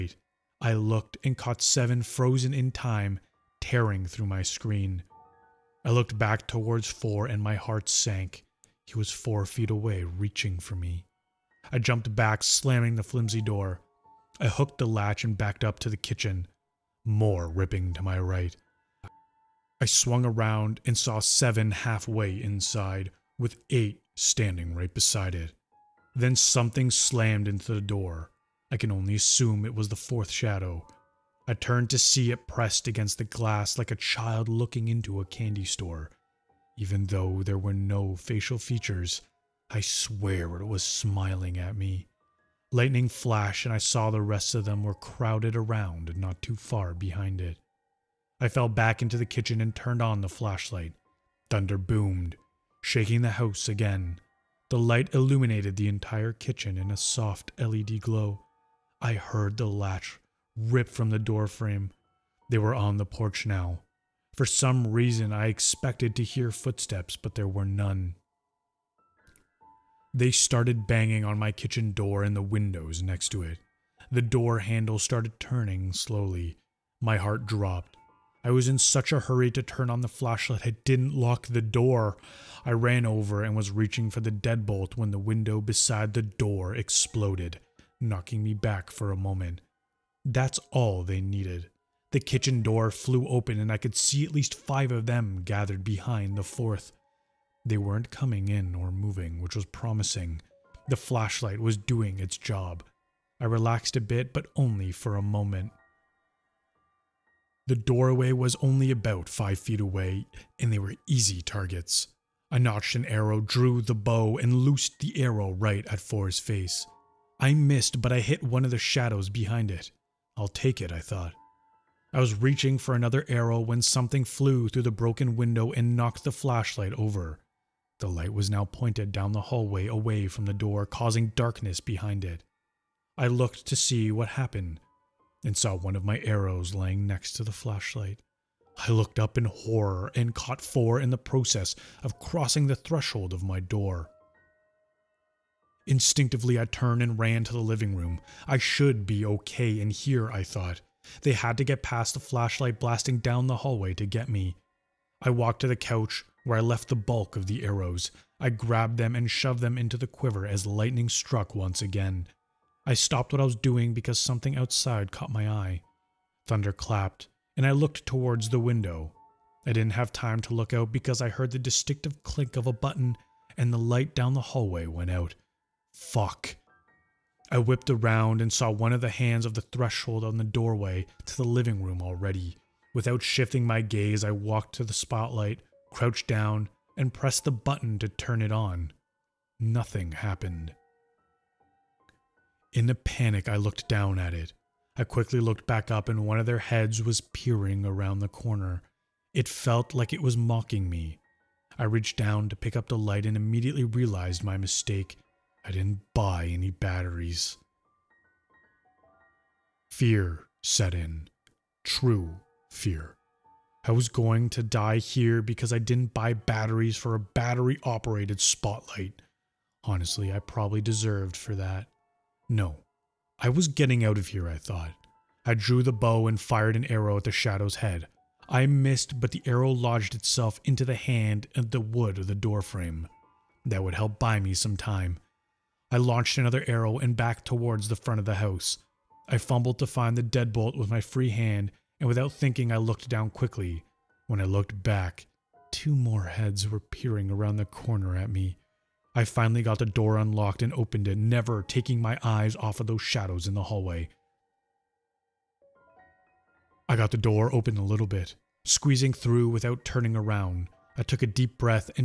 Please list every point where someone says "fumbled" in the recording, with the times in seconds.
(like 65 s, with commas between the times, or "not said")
239 s.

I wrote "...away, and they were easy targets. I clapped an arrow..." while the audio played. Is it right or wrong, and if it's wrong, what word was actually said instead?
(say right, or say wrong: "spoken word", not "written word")
wrong: "notched", not "clapped".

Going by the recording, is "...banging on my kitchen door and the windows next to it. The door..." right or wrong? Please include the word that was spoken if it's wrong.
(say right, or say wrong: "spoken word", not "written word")
right.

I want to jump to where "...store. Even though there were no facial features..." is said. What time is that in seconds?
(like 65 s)
35 s.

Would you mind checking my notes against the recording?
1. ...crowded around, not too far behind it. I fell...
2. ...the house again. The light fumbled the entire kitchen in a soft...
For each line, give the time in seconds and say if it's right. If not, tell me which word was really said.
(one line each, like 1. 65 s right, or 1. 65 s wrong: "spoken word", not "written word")
1. 44 s right
2. 53 s wrong: "illuminated", not "fumbled".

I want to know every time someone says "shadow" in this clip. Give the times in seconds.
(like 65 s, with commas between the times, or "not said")
30 s, 118 s, 227 s, 253 s.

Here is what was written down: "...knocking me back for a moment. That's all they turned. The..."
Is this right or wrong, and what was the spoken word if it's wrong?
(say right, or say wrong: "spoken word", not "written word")
wrong: "needed", not "turned".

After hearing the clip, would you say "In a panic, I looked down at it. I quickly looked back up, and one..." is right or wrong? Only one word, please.
right.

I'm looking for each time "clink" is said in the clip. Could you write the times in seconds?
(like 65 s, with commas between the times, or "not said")
172 s.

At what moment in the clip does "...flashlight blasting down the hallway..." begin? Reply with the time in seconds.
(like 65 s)
152 s.